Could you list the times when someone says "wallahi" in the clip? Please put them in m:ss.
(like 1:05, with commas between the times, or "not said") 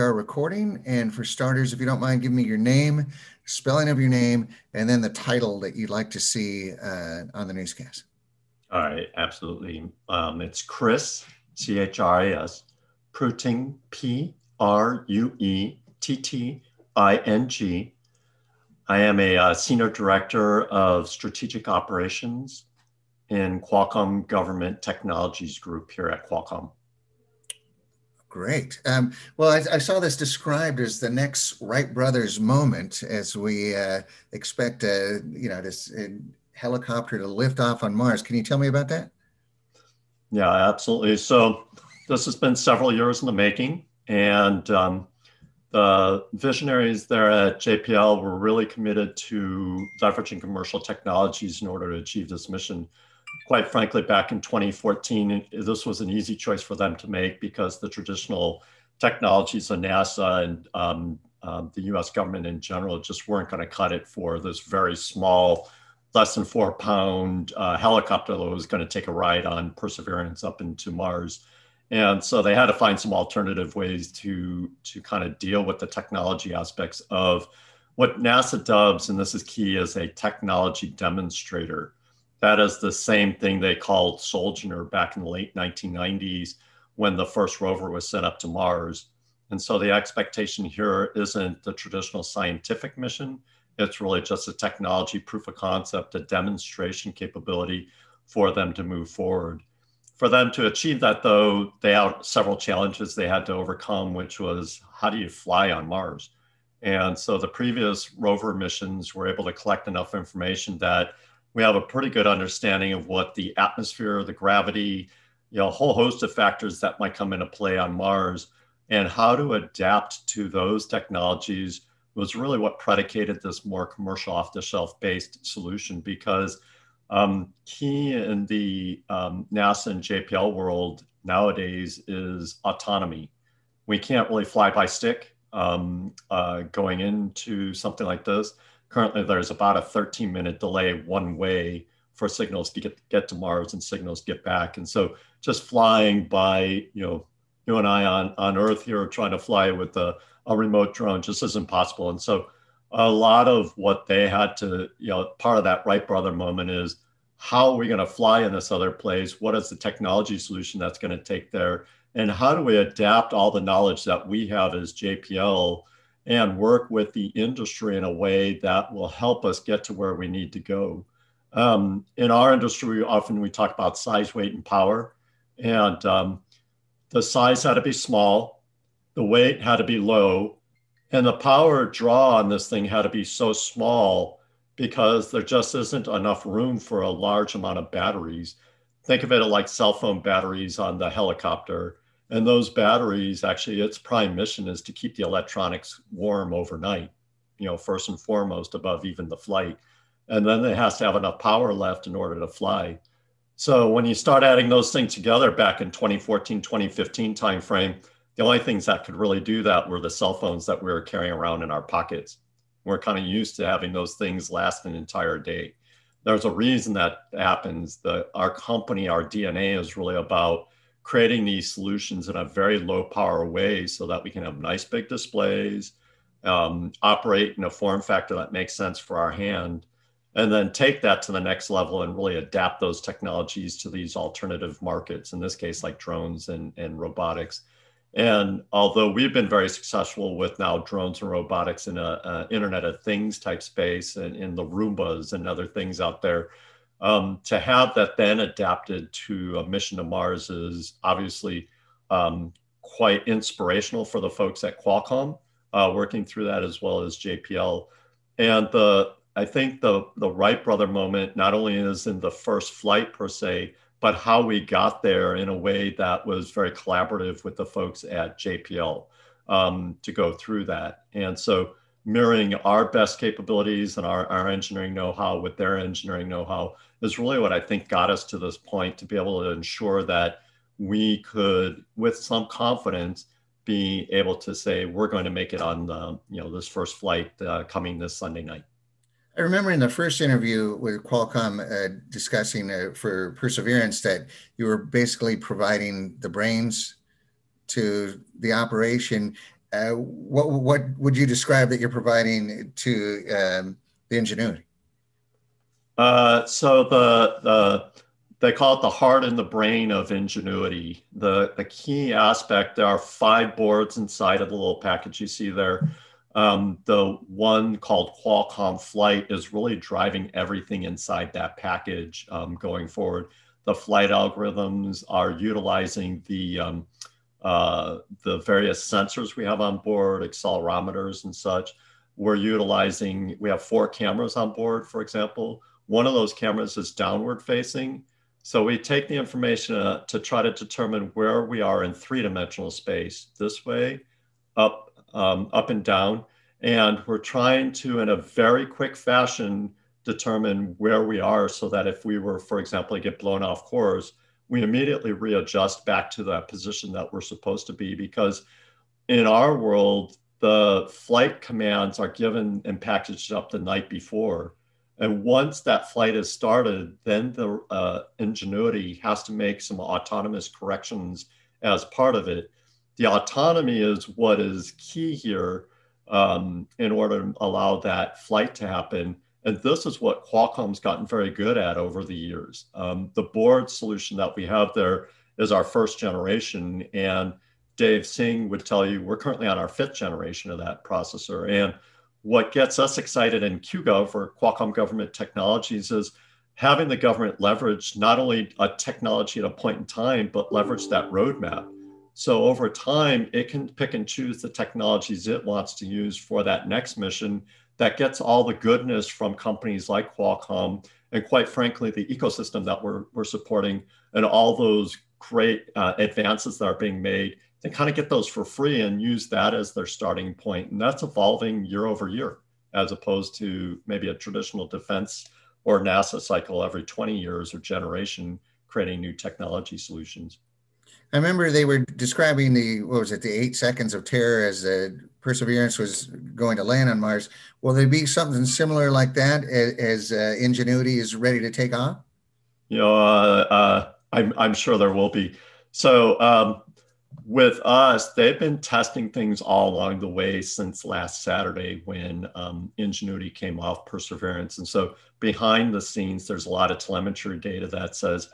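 not said.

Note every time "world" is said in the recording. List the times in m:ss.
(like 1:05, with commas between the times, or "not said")
2:10, 5:59.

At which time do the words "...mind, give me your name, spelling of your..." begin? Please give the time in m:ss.
0:02.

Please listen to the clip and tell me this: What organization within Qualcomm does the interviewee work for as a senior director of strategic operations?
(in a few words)
Qualcomm Government Technologies Group.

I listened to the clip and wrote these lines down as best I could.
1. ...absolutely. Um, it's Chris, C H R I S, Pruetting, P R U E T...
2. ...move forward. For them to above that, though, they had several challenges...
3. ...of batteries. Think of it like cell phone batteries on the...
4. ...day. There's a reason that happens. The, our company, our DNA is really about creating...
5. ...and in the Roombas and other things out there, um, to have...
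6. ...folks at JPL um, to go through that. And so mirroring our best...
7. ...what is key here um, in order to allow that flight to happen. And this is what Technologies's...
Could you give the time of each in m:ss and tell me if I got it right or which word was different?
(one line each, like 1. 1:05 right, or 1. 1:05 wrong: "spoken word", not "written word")
1. 0:09 right
2. 1:38 wrong: "achieve", not "above"
3. 3:07 right
4. 3:35 right
5. 4:04 right
6. 4:27 right
7. 6:14 wrong: "Qualcomm", not "Technologies".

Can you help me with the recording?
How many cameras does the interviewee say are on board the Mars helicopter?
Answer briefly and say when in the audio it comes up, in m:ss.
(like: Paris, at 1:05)
4, at 5:33.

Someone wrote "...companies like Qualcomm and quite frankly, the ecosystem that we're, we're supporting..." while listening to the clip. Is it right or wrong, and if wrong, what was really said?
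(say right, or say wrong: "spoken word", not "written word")
right.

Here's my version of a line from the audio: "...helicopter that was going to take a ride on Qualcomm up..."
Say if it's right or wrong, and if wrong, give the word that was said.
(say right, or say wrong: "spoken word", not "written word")
wrong: "Perseverance", not "Qualcomm".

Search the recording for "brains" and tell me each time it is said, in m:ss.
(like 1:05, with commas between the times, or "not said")
4:56, 5:09.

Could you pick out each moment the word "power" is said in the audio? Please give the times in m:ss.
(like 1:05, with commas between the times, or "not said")
2:54, 3:01, 3:21, 3:43.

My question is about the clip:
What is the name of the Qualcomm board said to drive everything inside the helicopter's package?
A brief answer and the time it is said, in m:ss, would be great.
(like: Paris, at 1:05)
Qualcomm Flight, at 5:18.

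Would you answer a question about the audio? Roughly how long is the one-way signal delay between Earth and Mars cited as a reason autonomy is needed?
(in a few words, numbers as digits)
13 minutes.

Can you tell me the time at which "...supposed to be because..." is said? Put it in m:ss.
5:57.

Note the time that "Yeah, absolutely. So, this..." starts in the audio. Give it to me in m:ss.
0:40.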